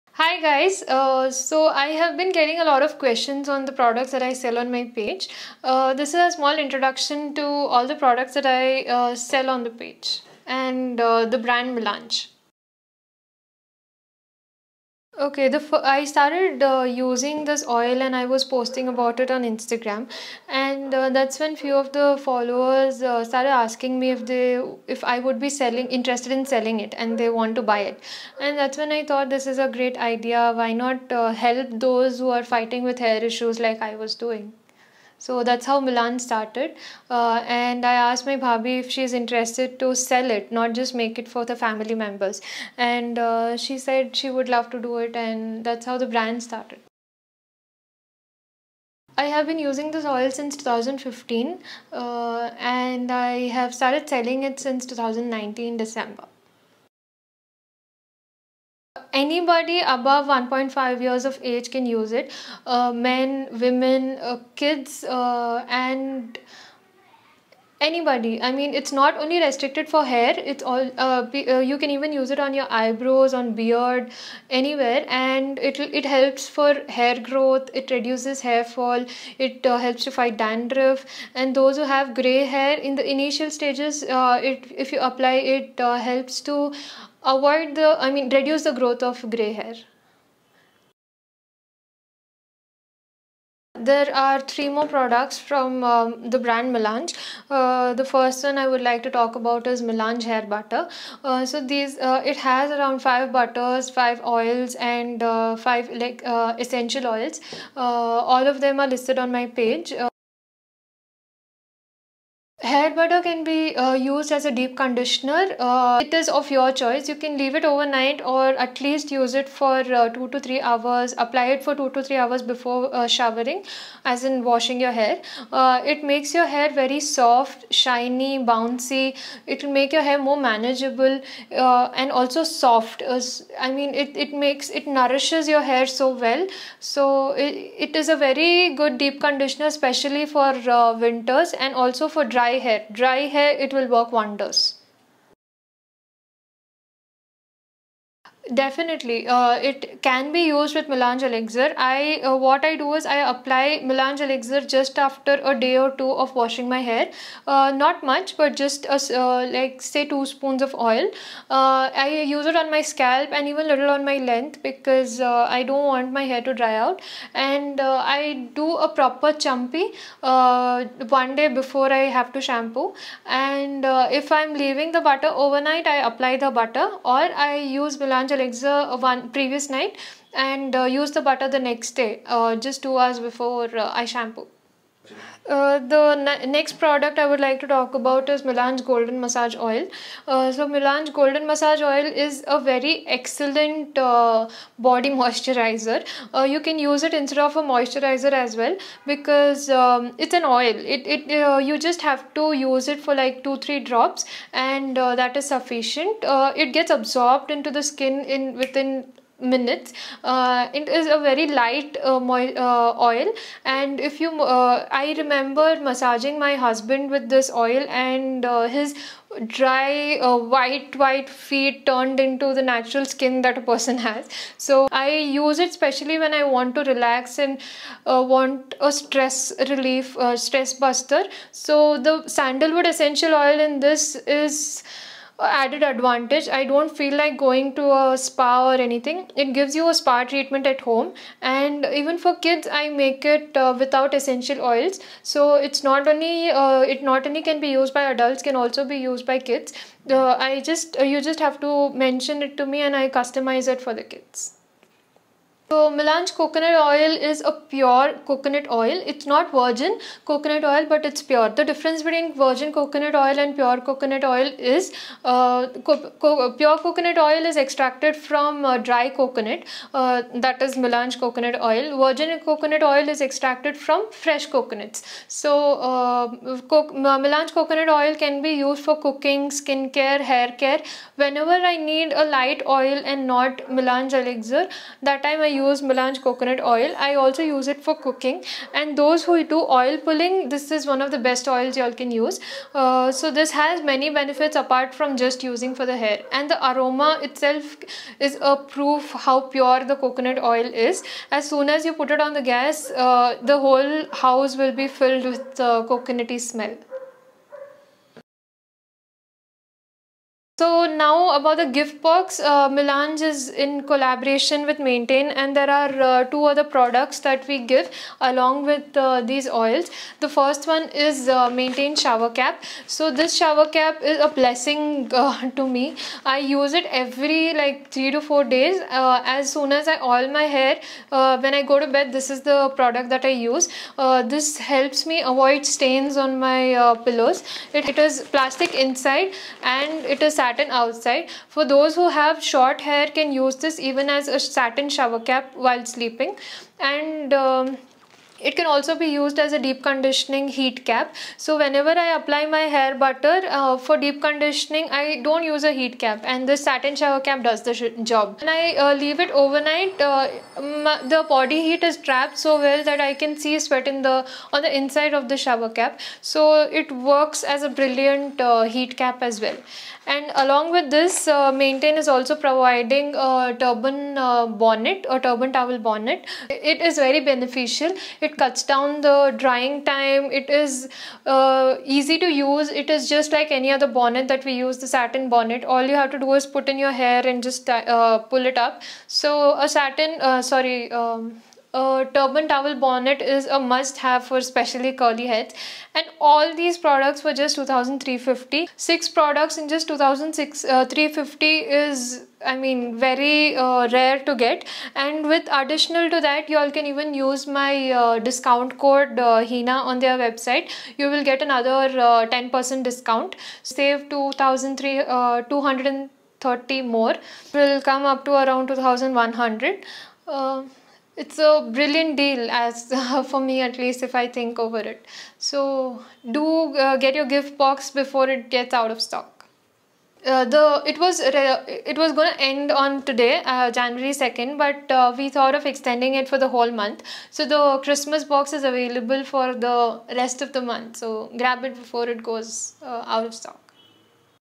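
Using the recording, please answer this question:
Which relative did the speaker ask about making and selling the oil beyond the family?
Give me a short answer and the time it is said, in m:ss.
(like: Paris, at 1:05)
bhabi, at 0:38.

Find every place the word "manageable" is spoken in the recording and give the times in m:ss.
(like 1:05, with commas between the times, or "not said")
2:10.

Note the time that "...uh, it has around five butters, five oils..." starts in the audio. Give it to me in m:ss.
1:41.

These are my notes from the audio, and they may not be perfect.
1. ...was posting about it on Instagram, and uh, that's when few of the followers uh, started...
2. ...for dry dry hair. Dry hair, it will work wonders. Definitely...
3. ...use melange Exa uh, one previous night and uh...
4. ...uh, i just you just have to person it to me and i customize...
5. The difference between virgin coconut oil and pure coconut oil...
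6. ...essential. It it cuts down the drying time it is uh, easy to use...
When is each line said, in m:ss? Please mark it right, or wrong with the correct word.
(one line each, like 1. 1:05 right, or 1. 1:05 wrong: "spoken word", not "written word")
1. 0:18 right
2. 2:22 right
3. 2:57 right
4. 4:10 wrong: "mention", not "person"
5. 4:21 right
6. 6:17 wrong: "beneficial", not "essential".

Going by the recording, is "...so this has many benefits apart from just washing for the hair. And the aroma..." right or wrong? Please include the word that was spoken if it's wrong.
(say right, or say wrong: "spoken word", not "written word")
wrong: "using", not "washing".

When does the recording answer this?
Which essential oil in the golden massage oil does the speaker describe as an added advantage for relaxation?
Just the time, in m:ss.
3:52.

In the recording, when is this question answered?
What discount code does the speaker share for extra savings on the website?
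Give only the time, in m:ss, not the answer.
6:49.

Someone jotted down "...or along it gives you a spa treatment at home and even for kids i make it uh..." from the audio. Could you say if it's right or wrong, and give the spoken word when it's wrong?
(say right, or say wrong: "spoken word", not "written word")
wrong: "anything", not "along".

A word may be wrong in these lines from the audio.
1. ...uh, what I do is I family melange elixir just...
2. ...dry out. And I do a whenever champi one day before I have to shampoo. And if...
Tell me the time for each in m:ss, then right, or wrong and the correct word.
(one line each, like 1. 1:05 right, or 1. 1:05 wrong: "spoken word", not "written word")
1. 2:32 wrong: "apply", not "family"
2. 2:46 wrong: "proper", not "whenever".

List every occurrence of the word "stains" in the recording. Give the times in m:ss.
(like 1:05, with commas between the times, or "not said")
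5:35.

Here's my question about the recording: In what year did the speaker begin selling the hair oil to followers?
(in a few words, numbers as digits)
2019.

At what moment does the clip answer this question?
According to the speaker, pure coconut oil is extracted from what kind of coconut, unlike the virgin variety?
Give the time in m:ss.
4:28.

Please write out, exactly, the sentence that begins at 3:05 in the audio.
Uh, the ne next product I would like to talk about is Melange Golden Massage Oil.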